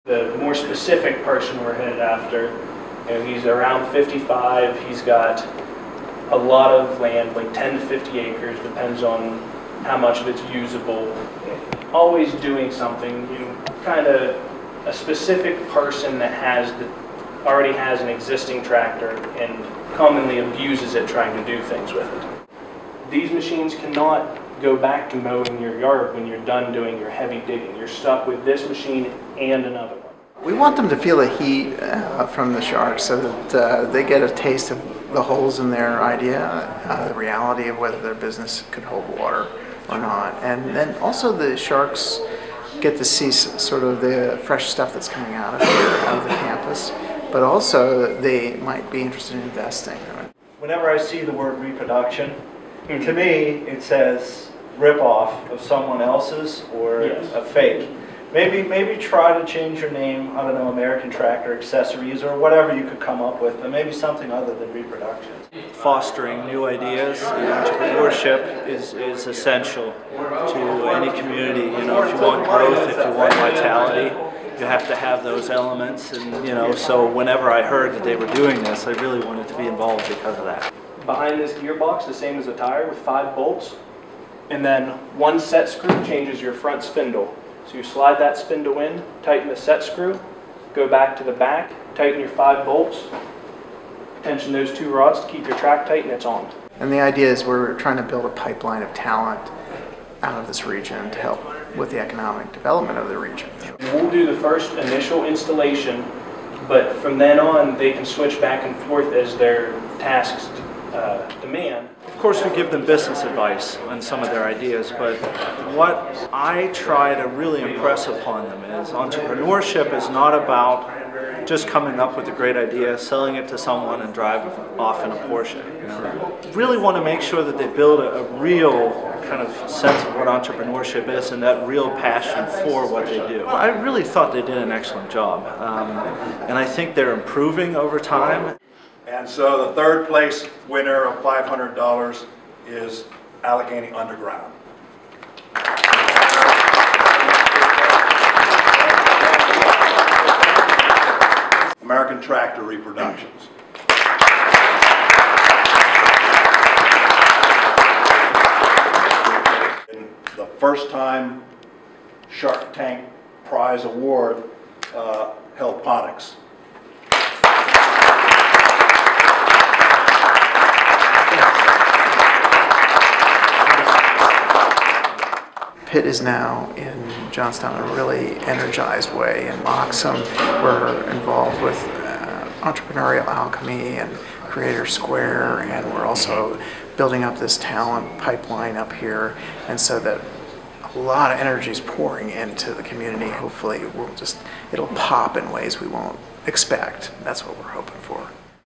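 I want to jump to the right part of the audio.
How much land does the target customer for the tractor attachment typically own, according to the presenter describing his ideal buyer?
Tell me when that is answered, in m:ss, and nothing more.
0:07.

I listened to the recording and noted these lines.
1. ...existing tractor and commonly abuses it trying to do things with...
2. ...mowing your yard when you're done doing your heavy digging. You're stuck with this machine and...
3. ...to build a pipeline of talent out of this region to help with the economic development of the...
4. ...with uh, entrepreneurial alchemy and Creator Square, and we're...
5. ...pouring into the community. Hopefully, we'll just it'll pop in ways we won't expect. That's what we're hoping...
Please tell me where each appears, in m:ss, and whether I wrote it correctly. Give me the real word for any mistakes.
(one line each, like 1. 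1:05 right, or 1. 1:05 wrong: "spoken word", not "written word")
1. 0:18 right
2. 0:25 right
3. 1:37 right
4. 3:01 right
5. 3:11 right.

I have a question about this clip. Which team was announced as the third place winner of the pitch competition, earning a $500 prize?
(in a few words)
Allegheny Underground.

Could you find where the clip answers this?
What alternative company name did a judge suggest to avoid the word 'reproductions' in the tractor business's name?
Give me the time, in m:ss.
1:00.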